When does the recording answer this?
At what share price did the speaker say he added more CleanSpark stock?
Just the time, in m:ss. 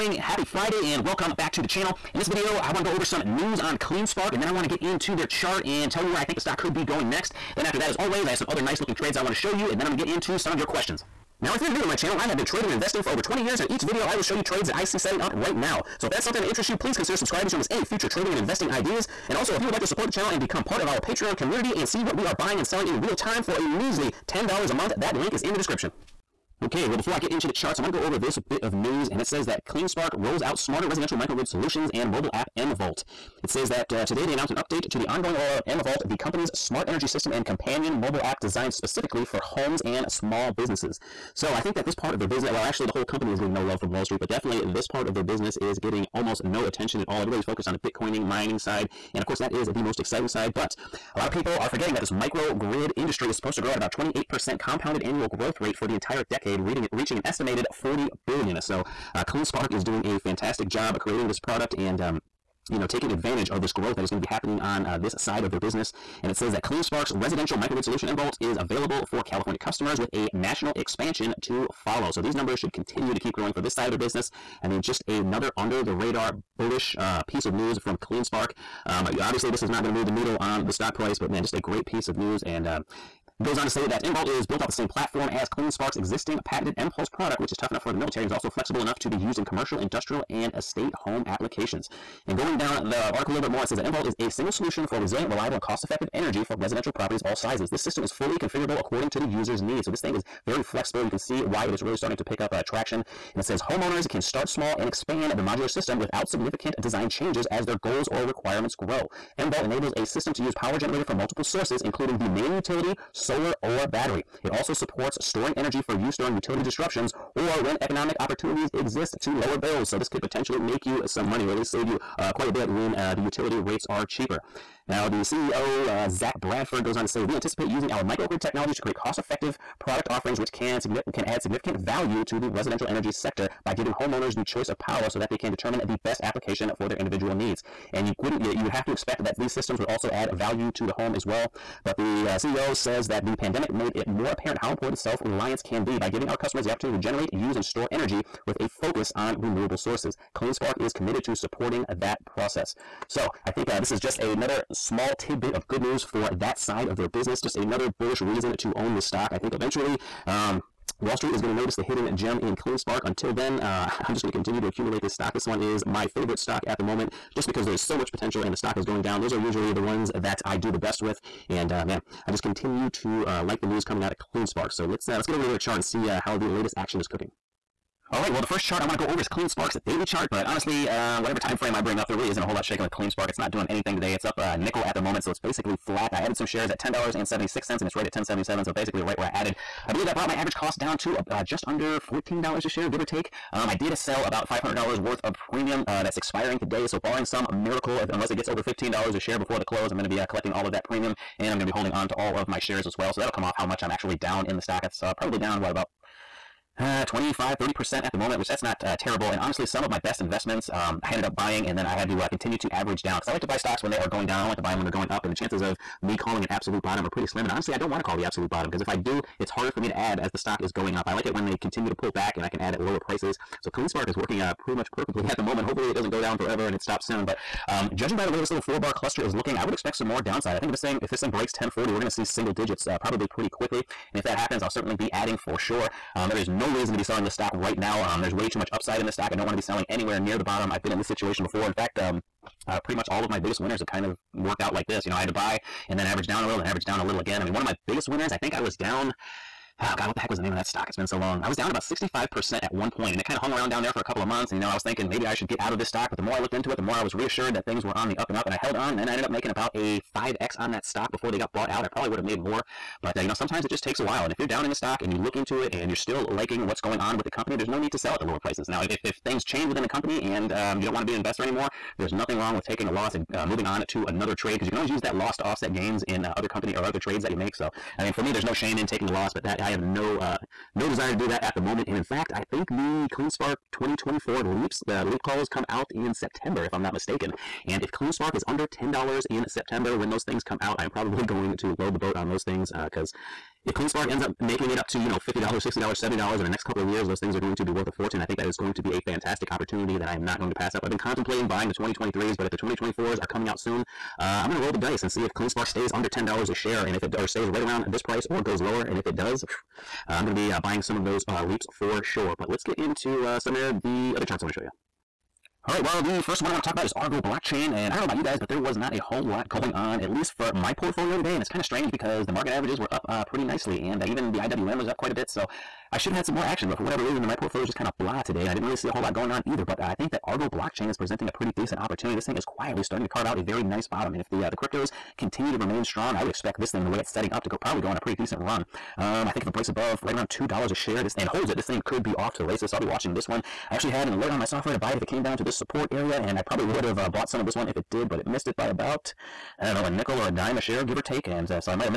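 3:06.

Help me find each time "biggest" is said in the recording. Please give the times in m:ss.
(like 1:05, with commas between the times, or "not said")
4:03, 4:07.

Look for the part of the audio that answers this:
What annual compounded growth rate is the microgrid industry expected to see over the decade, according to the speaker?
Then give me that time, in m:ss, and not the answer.
0:53.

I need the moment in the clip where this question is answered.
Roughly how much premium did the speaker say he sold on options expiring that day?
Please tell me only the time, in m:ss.
3:14.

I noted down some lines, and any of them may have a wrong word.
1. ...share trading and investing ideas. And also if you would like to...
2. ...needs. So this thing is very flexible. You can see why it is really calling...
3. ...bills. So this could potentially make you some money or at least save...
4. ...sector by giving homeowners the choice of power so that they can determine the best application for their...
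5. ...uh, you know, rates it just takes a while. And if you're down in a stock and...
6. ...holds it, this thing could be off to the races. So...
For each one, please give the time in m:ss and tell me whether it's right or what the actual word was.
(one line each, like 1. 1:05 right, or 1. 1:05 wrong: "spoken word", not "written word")
1. 0:17 wrong: "future", not "share"
2. 1:39 wrong: "starting", not "calling"
3. 1:59 right
4. 2:13 right
5. 4:23 wrong: "sometimes", not "rates"
6. 5:41 right.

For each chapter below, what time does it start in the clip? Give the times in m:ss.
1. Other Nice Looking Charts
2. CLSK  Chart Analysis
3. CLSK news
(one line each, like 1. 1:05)
1. 5:15
2. 2:58
3. 0:29.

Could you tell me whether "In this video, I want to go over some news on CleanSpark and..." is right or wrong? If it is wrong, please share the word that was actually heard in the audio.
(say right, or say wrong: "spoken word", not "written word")
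right.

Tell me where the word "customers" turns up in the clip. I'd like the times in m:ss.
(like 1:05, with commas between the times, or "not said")
1:09, 2:26.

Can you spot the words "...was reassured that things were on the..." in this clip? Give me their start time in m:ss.
4:17.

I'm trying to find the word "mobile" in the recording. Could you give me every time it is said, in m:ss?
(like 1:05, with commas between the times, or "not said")
0:32, 0:37.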